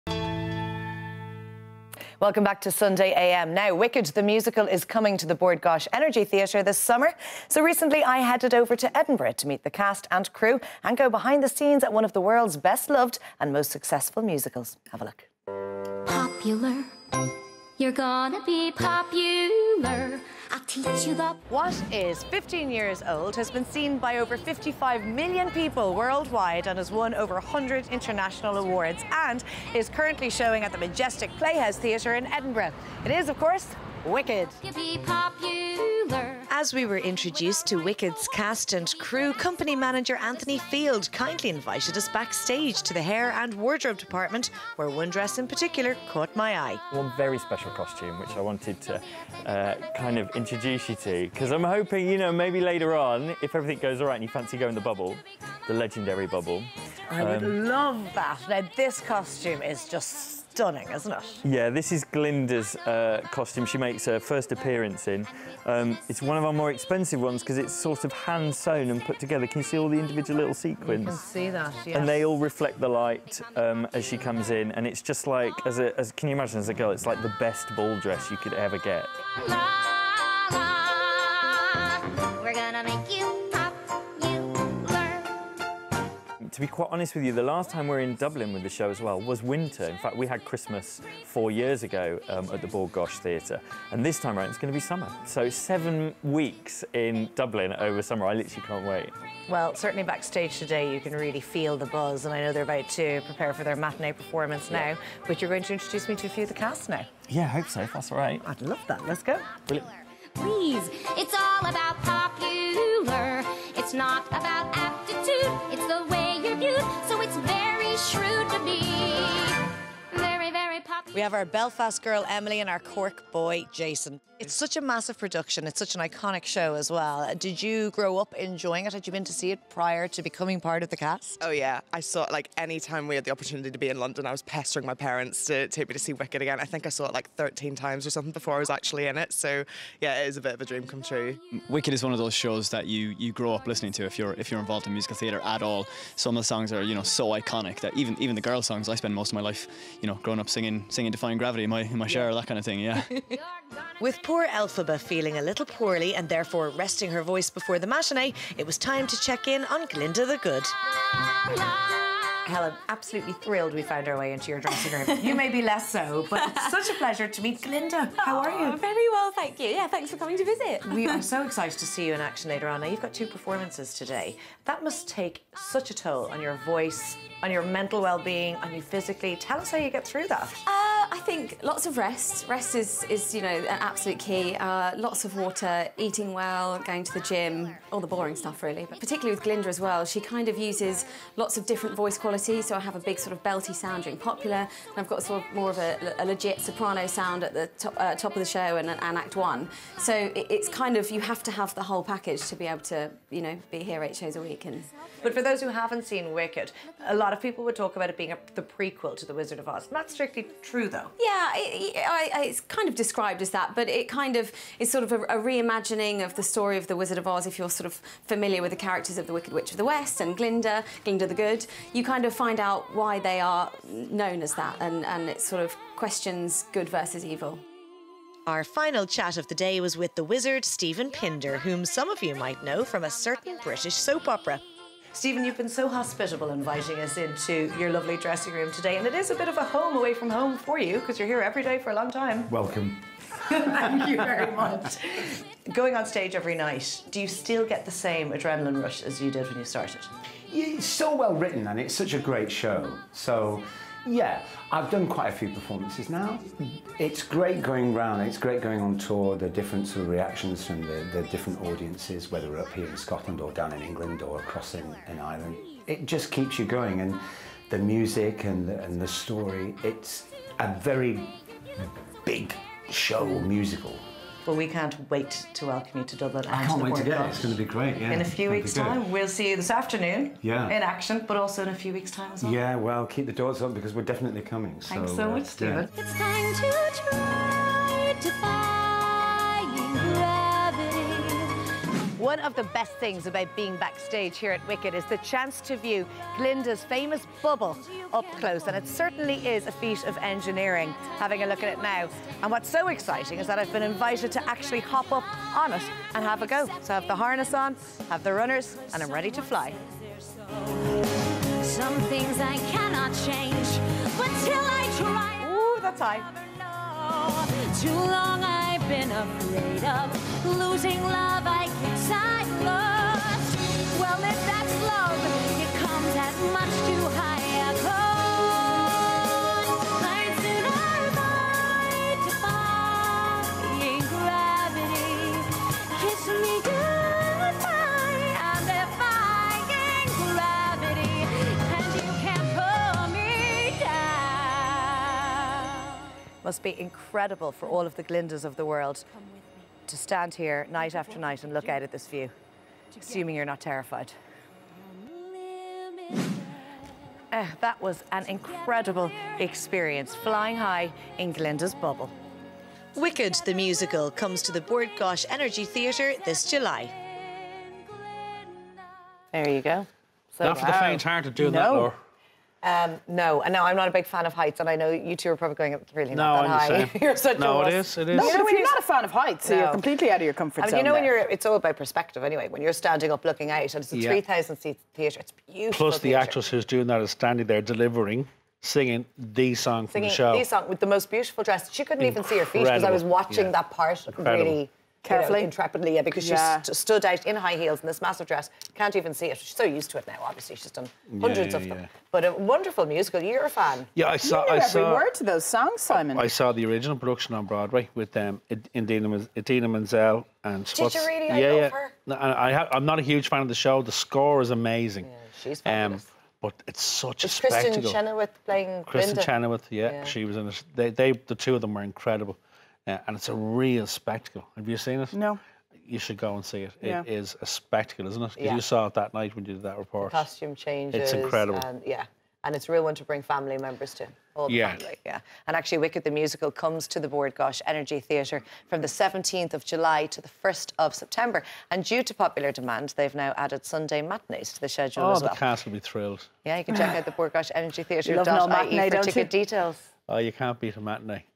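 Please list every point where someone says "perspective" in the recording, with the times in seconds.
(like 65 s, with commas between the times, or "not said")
381 s.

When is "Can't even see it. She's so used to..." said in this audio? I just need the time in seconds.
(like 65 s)
398 s.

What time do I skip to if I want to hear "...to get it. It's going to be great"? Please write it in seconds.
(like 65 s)
276 s.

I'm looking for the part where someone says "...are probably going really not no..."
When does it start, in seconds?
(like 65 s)
375 s.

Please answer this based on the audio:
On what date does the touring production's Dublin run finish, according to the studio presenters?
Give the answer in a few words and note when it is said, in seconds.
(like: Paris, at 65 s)
1 September, at 440 s.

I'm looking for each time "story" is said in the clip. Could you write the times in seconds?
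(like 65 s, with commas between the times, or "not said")
216 s, 269 s.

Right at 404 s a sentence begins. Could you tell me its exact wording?
You knew I every saw, word to those songs, Simon.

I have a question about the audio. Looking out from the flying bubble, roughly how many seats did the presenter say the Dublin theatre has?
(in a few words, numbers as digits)
3,000.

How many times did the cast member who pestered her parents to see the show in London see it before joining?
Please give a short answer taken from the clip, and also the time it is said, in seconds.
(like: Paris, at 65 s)
13, at 137 s.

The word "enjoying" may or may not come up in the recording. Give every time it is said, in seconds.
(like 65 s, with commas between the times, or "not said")
128 s.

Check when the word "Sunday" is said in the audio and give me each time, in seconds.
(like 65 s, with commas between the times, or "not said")
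2 s, 443 s.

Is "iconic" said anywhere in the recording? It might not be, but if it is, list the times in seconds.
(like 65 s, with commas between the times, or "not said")
126 s, 147 s.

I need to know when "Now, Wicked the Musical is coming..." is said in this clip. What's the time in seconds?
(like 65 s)
3 s.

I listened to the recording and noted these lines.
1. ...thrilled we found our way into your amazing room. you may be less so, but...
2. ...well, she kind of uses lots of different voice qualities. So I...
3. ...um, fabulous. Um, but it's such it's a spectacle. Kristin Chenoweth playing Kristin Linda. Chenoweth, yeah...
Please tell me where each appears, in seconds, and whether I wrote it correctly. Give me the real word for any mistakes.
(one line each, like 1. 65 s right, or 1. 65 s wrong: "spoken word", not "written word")
1. 163 s wrong: "dressing", not "amazing"
2. 189 s right
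3. 415 s right.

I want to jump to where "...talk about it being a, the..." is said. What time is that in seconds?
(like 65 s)
207 s.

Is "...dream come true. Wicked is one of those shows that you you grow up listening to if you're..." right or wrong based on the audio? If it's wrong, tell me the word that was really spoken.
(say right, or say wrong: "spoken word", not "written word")
right.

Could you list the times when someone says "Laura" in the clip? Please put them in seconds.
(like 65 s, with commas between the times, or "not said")
371 s.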